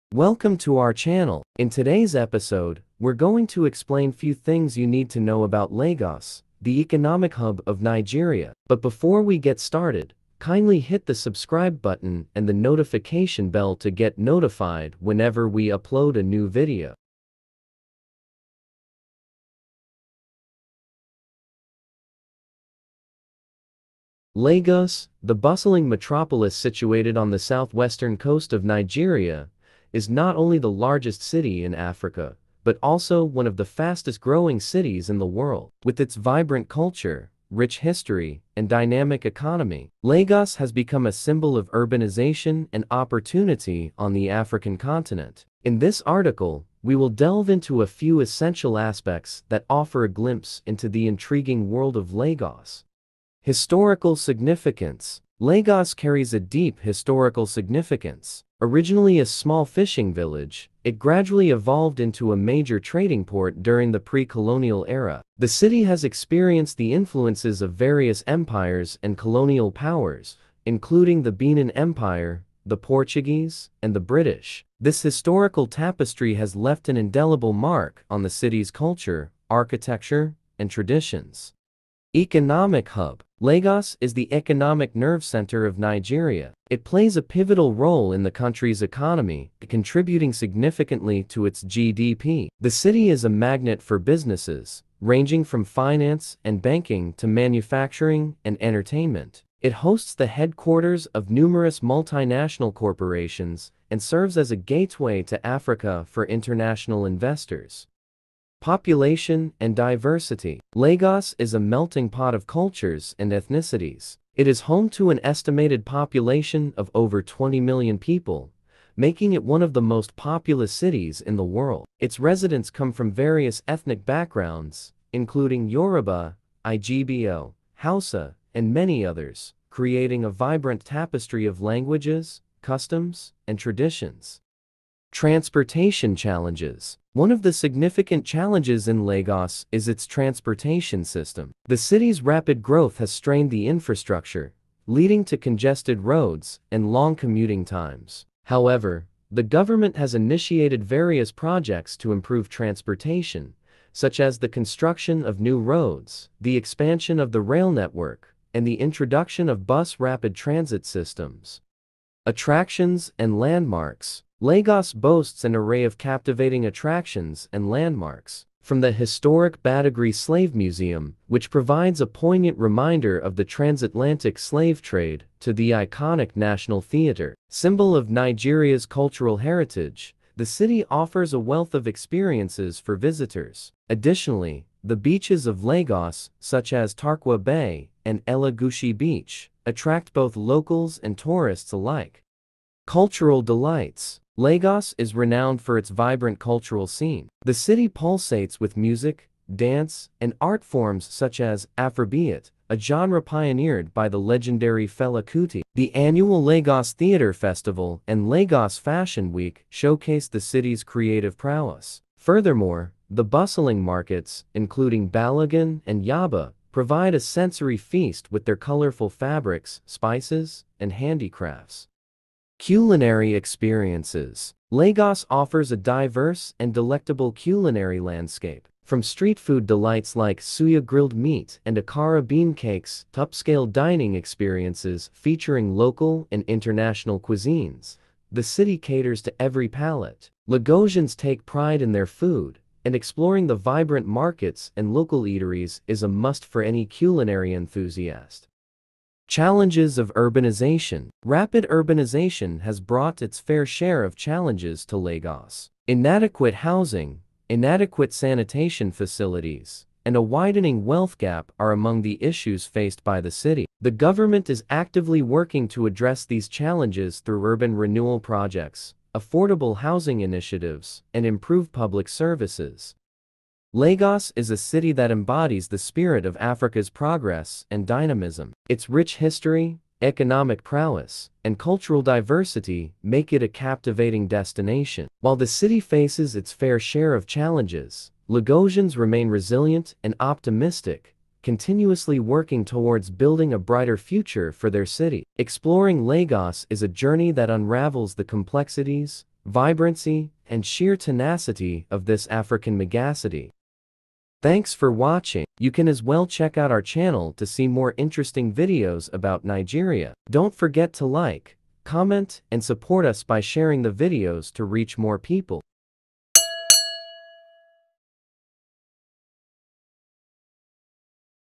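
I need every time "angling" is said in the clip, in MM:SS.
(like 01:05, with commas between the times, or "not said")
not said.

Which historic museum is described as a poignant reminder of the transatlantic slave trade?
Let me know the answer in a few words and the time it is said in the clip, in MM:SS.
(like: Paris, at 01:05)
Badagry Slave Museum, at 02:49.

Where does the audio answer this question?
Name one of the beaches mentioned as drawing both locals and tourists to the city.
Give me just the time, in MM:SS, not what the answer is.
03:06.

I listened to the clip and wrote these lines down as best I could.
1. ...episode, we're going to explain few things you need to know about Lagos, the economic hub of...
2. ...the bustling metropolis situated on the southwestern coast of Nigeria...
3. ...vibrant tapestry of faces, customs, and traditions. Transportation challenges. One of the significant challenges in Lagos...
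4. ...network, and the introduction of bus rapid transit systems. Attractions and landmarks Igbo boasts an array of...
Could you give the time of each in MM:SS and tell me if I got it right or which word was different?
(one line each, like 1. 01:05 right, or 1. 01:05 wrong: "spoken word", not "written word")
1. 00:02 right
2. 00:25 right
3. 02:10 wrong: "languages", not "faces"
4. 02:37 wrong: "Lagos", not "Igbo".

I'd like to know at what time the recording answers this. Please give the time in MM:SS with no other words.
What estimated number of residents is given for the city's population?
01:56.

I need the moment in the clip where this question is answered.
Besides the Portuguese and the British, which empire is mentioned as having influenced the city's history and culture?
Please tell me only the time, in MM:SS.
01:11.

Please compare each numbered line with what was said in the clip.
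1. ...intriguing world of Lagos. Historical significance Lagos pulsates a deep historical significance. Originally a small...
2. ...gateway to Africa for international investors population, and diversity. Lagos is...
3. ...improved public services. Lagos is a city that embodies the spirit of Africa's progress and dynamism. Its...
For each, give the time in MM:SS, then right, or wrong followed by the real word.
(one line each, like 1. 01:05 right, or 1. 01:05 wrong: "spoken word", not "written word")
1. 00:51 wrong: "carries", not "pulsates"
2. 01:44 right
3. 04:31 right.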